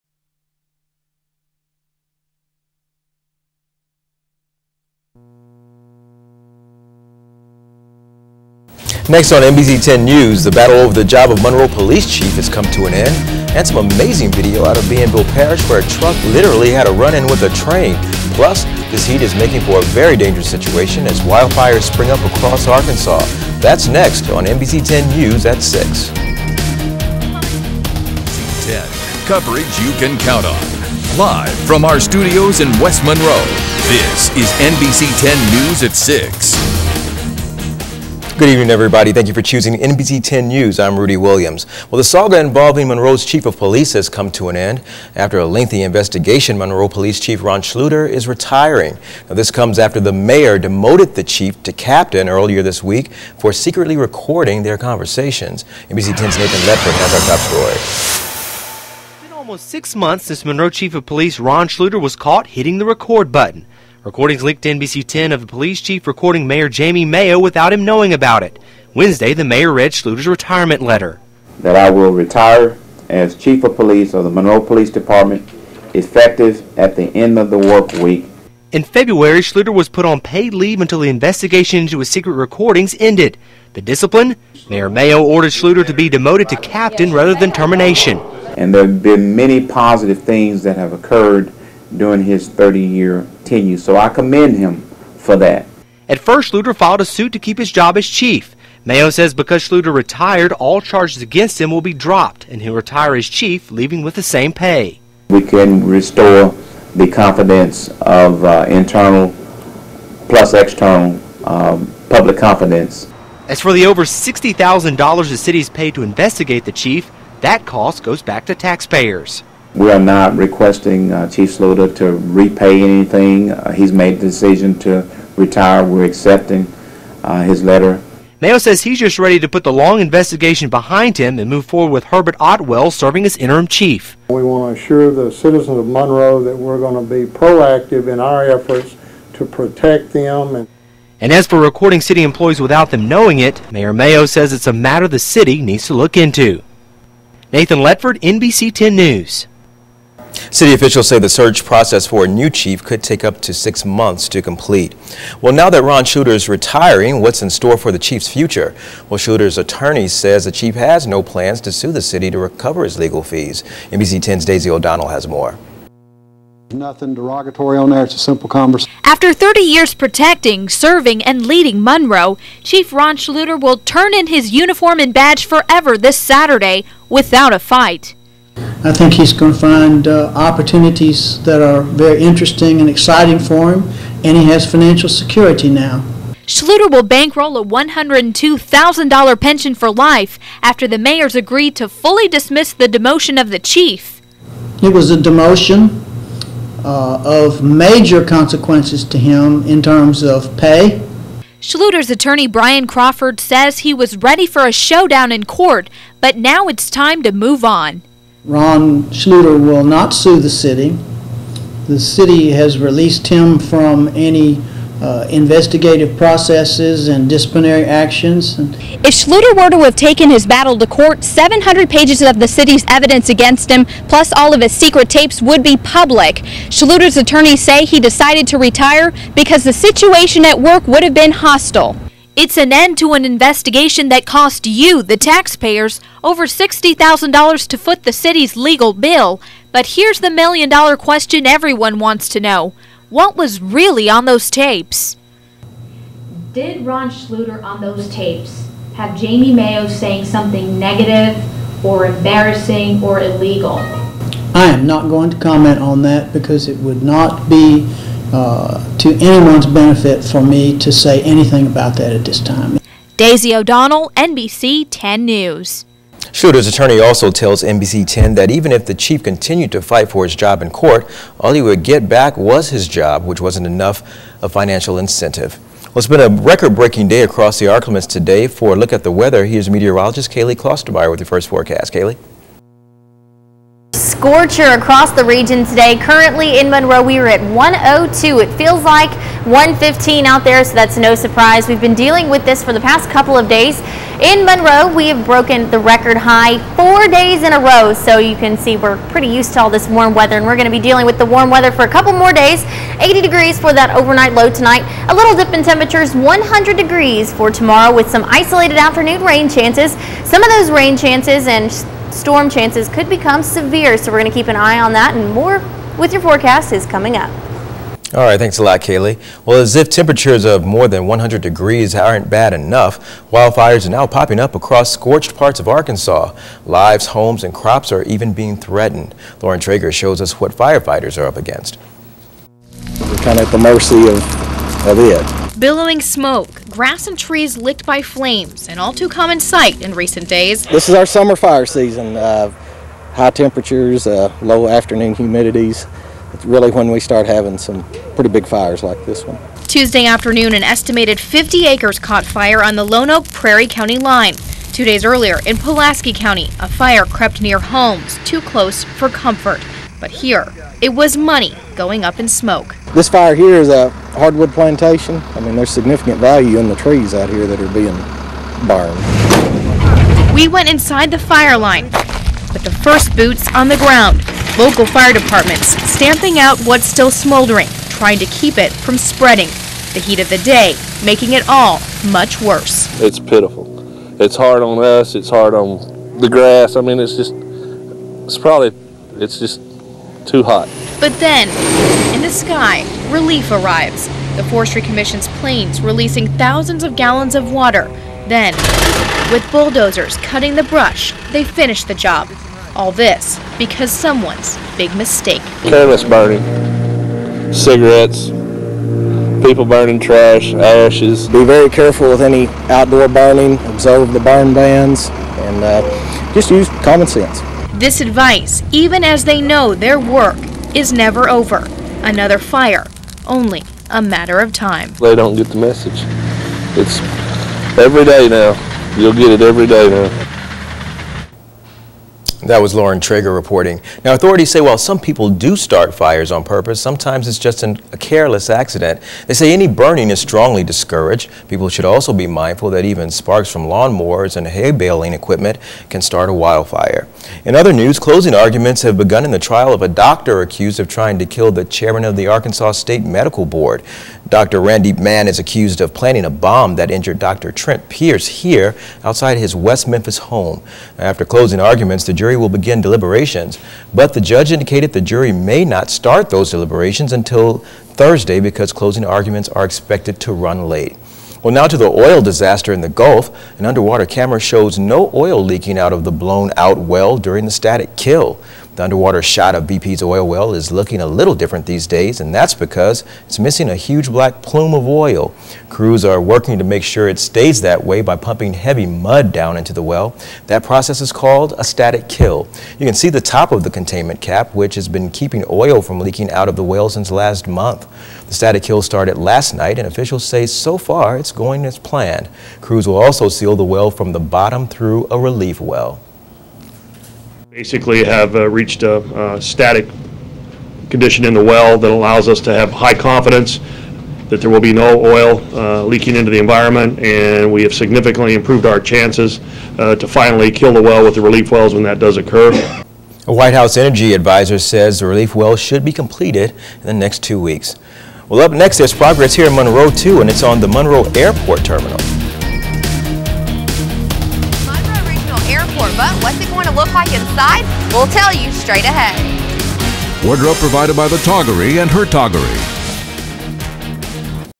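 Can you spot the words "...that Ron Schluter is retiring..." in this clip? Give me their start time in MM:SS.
02:35.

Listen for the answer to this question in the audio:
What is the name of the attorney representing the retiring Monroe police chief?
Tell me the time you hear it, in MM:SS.
03:22.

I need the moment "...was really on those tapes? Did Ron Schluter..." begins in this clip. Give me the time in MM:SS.
04:03.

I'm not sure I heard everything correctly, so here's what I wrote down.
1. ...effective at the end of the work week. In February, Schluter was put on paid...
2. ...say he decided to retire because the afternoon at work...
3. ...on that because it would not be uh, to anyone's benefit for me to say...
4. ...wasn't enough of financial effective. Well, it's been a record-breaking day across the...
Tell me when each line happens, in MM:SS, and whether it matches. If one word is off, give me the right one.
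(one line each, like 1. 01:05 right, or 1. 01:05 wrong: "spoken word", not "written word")
1. 01:15 right
2. 03:47 wrong: "situation", not "afternoon"
3. 04:15 right
4. 04:33 wrong: "incentive", not "effective".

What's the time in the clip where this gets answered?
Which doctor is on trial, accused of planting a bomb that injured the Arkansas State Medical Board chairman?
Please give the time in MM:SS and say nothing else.
07:34.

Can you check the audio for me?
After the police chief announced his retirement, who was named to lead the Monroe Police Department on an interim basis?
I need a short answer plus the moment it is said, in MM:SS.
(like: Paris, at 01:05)
Herbert Otwell, at 02:12.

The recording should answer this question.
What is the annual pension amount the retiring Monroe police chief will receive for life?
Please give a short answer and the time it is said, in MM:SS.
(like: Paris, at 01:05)
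$102,000, at 03:07.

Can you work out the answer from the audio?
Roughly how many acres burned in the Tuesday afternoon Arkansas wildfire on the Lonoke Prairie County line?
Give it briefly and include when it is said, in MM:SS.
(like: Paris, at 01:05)
50, at 05:51.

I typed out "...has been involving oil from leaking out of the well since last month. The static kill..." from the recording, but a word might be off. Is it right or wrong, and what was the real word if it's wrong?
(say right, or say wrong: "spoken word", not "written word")
wrong: "keeping", not "involving".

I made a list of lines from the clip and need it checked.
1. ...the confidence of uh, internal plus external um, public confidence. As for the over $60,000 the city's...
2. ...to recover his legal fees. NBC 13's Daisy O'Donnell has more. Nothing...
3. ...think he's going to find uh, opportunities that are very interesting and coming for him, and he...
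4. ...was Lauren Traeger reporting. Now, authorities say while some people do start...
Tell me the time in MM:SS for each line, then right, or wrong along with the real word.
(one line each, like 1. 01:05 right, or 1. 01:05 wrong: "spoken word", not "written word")
1. 01:46 right
2. 02:42 wrong: "10", not "13"
3. 02:58 wrong: "exciting", not "coming"
4. 07:12 right.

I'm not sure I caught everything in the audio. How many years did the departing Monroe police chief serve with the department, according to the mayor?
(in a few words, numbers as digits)
30.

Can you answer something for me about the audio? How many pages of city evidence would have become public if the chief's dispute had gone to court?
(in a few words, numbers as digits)
700.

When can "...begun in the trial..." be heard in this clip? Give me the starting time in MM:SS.
07:28.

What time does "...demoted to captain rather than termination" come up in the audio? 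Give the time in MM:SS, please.
01:26.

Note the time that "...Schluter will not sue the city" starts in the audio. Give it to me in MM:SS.
03:29.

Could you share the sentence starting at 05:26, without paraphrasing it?
Lives, homes, and crops are even being threatened.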